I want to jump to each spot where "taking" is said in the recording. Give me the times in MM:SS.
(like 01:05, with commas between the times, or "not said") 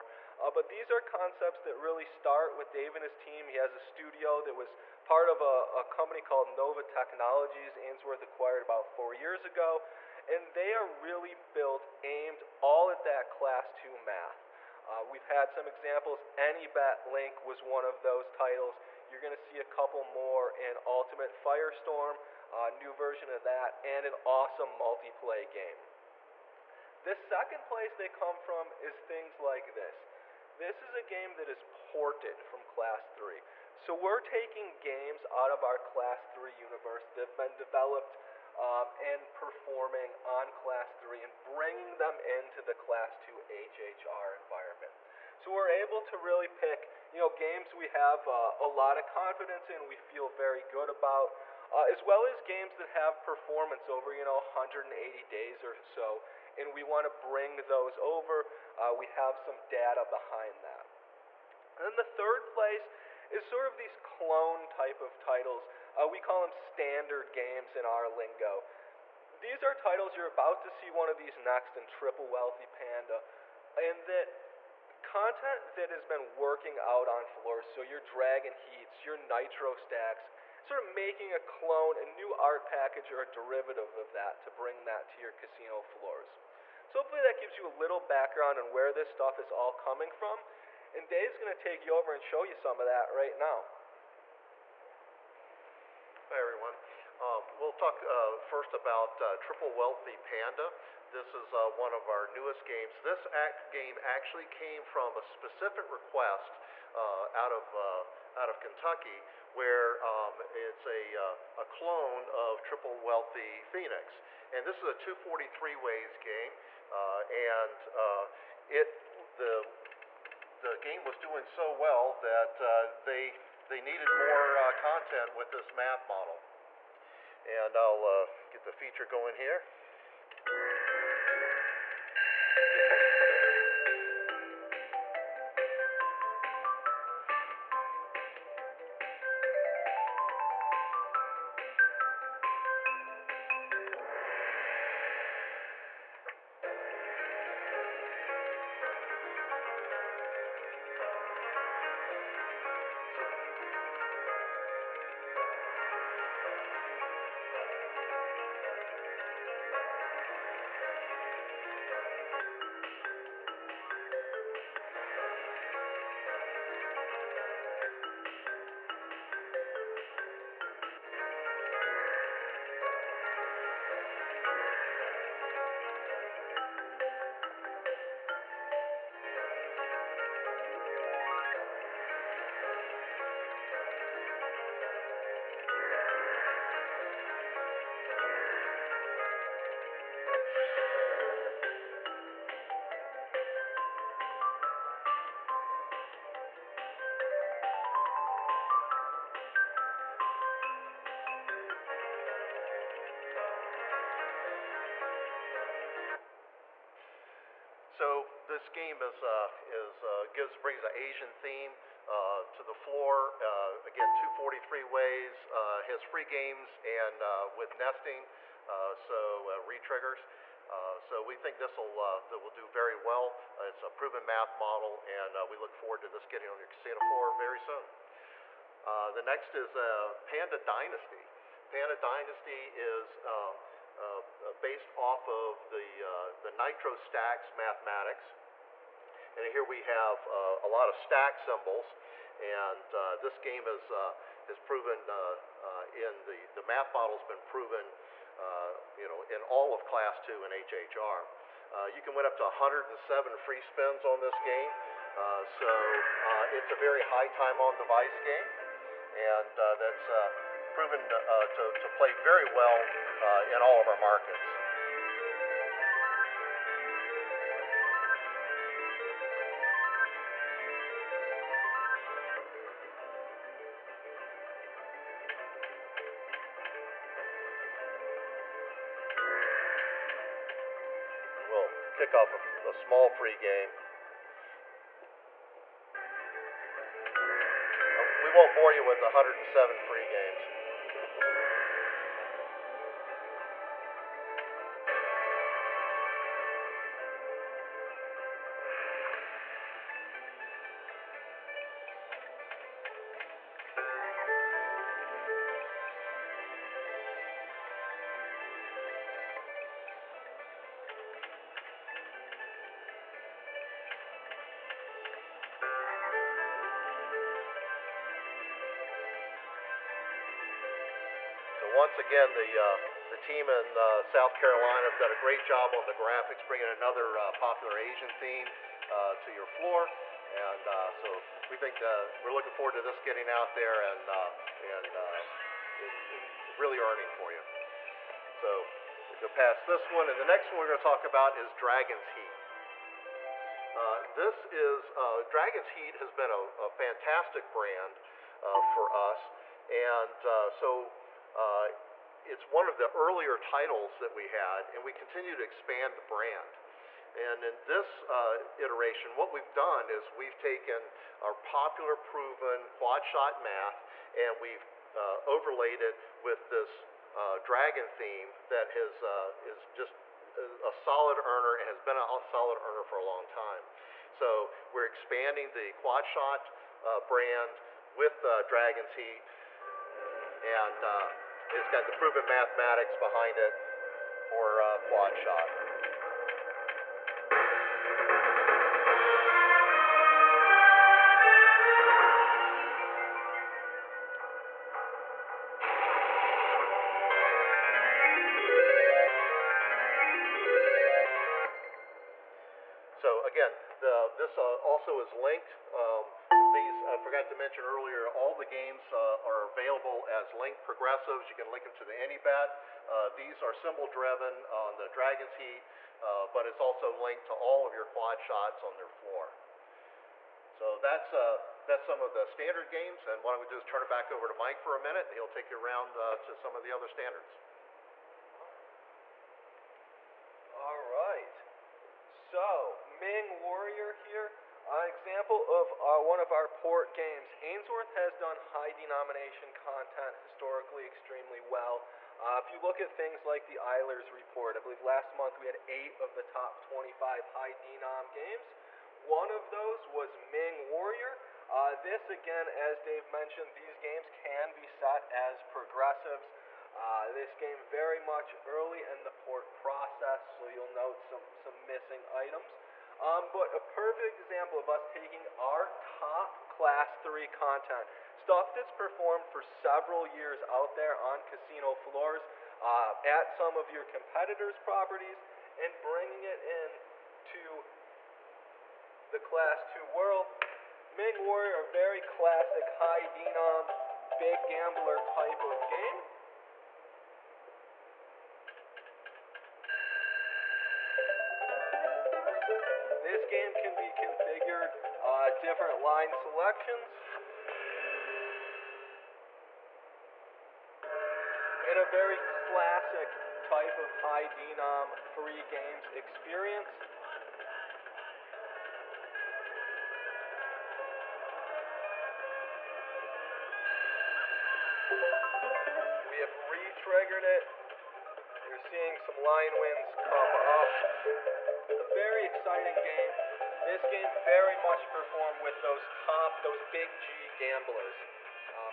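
00:34, 07:44.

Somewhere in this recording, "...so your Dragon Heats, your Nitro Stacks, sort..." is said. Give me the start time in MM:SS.
01:17.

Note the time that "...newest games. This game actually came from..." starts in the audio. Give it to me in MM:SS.
01:42.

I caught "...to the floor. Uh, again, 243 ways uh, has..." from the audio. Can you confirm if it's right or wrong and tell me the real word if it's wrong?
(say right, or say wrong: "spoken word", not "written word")
right.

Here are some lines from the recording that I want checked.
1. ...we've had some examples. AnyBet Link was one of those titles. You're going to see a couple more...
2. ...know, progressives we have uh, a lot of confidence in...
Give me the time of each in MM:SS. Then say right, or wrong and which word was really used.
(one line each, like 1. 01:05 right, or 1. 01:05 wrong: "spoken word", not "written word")
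1. 00:15 right
2. 00:47 wrong: "games", not "progressives".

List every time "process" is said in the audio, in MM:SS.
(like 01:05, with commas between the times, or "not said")
07:39.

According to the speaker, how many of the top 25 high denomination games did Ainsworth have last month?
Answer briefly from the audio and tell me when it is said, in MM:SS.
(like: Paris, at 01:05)
8, at 07:25.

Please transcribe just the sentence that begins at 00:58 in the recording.
Uh, we have some data behind that.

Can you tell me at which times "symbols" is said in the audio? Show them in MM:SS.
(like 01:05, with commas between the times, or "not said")
04:01, 06:53.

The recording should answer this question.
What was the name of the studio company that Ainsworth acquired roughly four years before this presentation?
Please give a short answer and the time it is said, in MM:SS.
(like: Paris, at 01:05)
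Nova Technologies, at 00:06.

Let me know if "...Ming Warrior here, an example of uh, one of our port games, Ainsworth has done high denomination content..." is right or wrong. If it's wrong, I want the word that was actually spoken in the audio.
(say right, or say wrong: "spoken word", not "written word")
right.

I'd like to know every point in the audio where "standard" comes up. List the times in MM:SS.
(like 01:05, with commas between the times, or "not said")
01:06, 07:02, 07:06.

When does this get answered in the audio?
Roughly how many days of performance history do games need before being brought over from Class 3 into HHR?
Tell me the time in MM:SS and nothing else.
00:54.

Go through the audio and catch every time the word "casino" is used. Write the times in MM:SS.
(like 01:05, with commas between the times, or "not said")
01:25, 03:46, 07:51.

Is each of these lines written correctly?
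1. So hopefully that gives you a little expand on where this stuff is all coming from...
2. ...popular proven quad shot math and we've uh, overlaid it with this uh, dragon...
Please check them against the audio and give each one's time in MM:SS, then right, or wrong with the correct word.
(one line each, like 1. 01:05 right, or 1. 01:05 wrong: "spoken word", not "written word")
1. 01:26 wrong: "background", not "expand"
2. 06:01 right.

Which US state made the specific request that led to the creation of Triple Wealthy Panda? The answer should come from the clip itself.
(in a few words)
Kentucky.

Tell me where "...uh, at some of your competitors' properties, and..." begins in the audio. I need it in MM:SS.
07:52.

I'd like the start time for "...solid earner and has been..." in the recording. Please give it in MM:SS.
06:10.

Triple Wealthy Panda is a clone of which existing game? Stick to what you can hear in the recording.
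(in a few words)
Triple Wealthy Phoenix.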